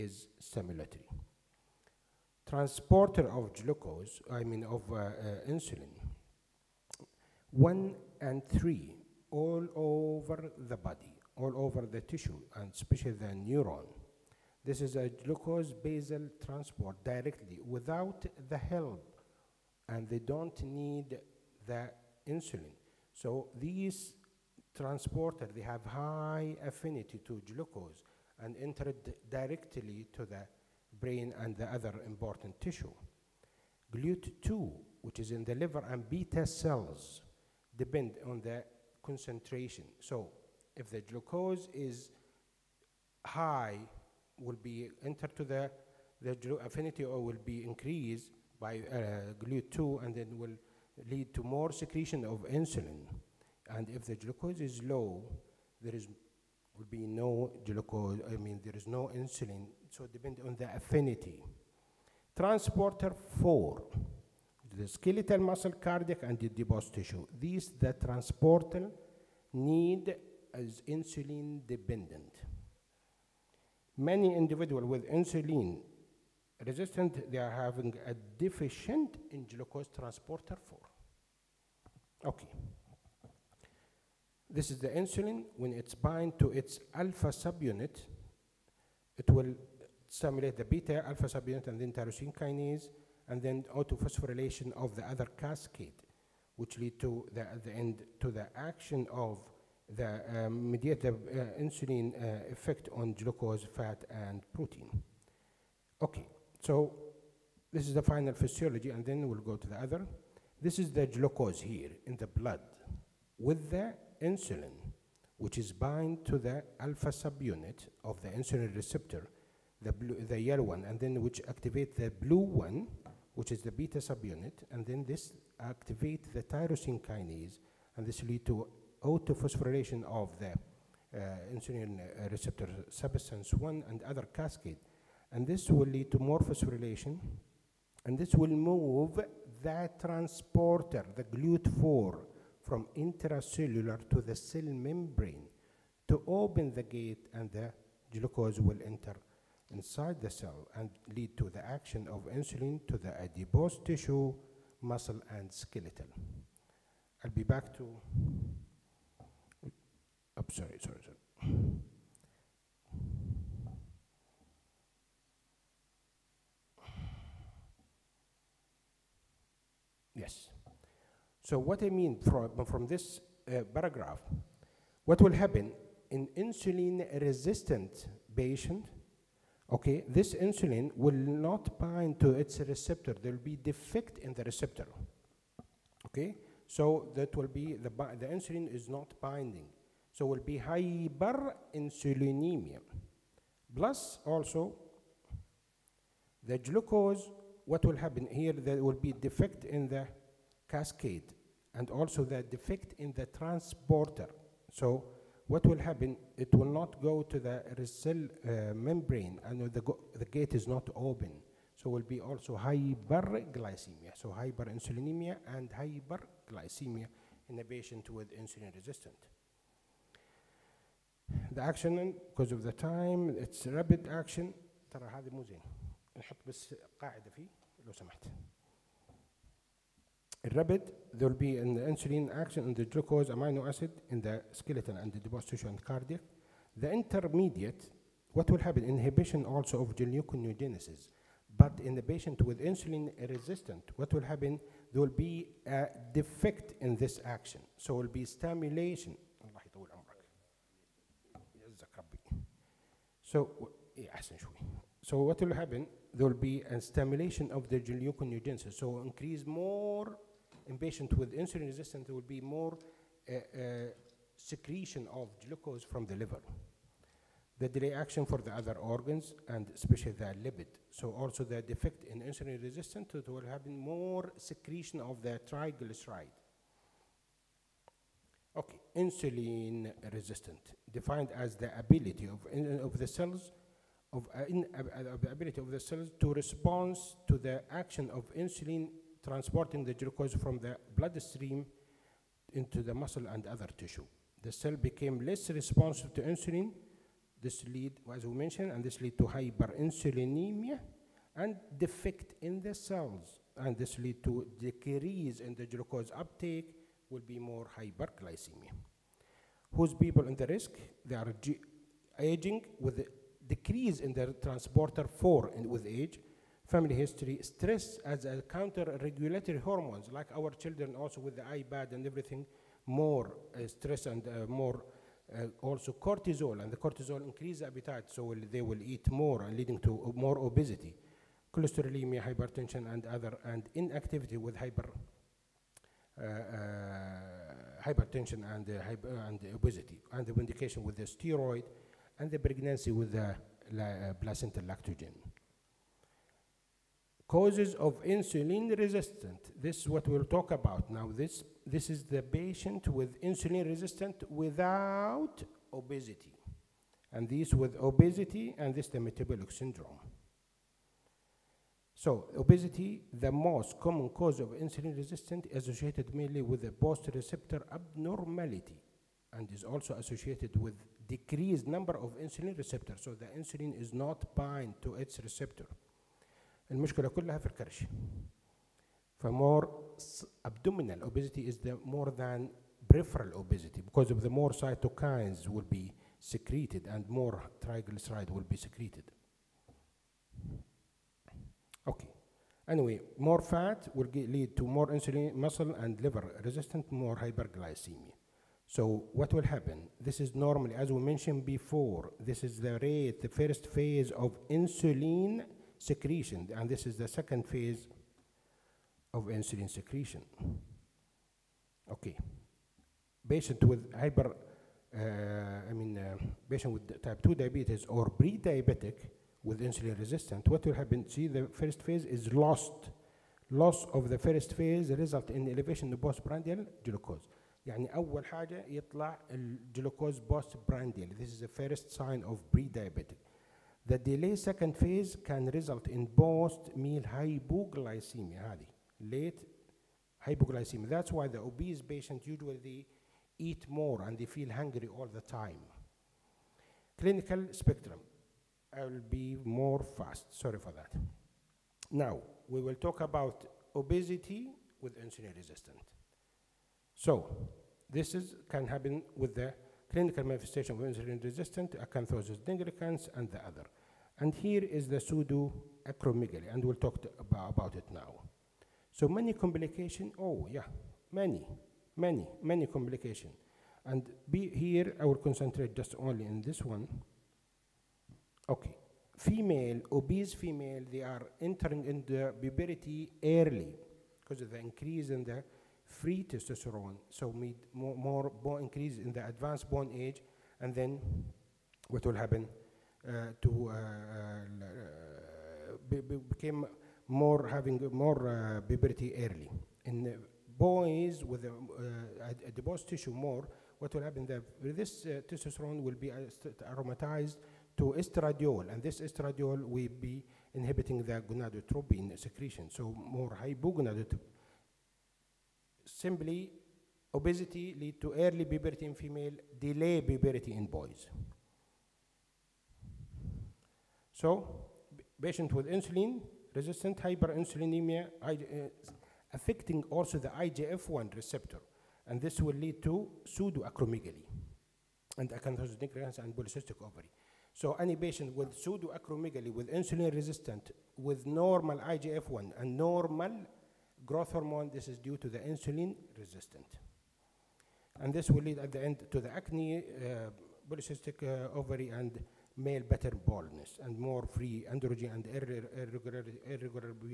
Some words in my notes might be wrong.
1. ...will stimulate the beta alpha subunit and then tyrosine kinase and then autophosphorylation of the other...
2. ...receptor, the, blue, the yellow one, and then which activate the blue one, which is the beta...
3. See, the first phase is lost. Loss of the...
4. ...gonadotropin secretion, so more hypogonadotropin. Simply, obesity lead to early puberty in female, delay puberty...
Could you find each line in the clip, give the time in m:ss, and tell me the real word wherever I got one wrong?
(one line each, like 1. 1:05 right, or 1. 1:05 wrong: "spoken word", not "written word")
1. 1:29 right
2. 1:58 right
3. 7:01 right
4. 8:31 right.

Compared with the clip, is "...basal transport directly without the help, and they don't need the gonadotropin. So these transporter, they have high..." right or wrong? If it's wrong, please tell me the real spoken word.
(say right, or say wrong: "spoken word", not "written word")
wrong: "insulin", not "gonadotropin".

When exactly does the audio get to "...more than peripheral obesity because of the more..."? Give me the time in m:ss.
6:21.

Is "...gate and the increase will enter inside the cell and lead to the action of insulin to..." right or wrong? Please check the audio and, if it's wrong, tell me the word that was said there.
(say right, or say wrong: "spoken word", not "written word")
wrong: "glucose", not "increase".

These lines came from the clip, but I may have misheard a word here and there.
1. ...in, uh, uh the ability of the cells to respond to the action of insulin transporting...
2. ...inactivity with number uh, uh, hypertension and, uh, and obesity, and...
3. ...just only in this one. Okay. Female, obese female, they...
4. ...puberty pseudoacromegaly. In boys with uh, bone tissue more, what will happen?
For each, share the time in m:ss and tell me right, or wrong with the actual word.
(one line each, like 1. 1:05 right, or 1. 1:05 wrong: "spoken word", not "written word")
1. 4:44 right
2. 5:33 wrong: "hyper", not "number"
3. 7:55 right
4. 8:18 wrong: "early", not "pseudoacromegaly".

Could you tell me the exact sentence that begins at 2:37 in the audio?
I'll be back to I'm sorry, sorry, sorry.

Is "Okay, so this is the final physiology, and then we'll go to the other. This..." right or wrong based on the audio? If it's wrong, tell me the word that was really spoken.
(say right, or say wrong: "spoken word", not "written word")
right.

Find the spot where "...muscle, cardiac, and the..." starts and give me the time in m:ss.
1:05.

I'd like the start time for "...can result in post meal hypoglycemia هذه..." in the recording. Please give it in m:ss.
7:15.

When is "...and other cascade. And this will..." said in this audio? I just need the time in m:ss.
2:13.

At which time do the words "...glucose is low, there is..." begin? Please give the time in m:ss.
0:54.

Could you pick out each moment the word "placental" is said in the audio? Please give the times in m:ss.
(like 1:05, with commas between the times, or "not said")
5:44.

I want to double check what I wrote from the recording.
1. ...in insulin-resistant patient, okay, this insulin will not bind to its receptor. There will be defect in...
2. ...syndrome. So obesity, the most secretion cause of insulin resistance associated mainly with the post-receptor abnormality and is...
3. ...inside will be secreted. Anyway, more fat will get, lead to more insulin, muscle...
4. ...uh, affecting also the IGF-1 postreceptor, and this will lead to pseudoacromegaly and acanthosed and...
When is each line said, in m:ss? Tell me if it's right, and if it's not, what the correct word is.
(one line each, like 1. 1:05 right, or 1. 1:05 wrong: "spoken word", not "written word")
1. 2:56 right
2. 5:59 wrong: "common", not "secretion"
3. 6:27 wrong: "triglyceride", not "inside"
4. 8:48 wrong: "receptor", not "postreceptor".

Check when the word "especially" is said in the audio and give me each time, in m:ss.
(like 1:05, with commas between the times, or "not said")
0:12, 4:29.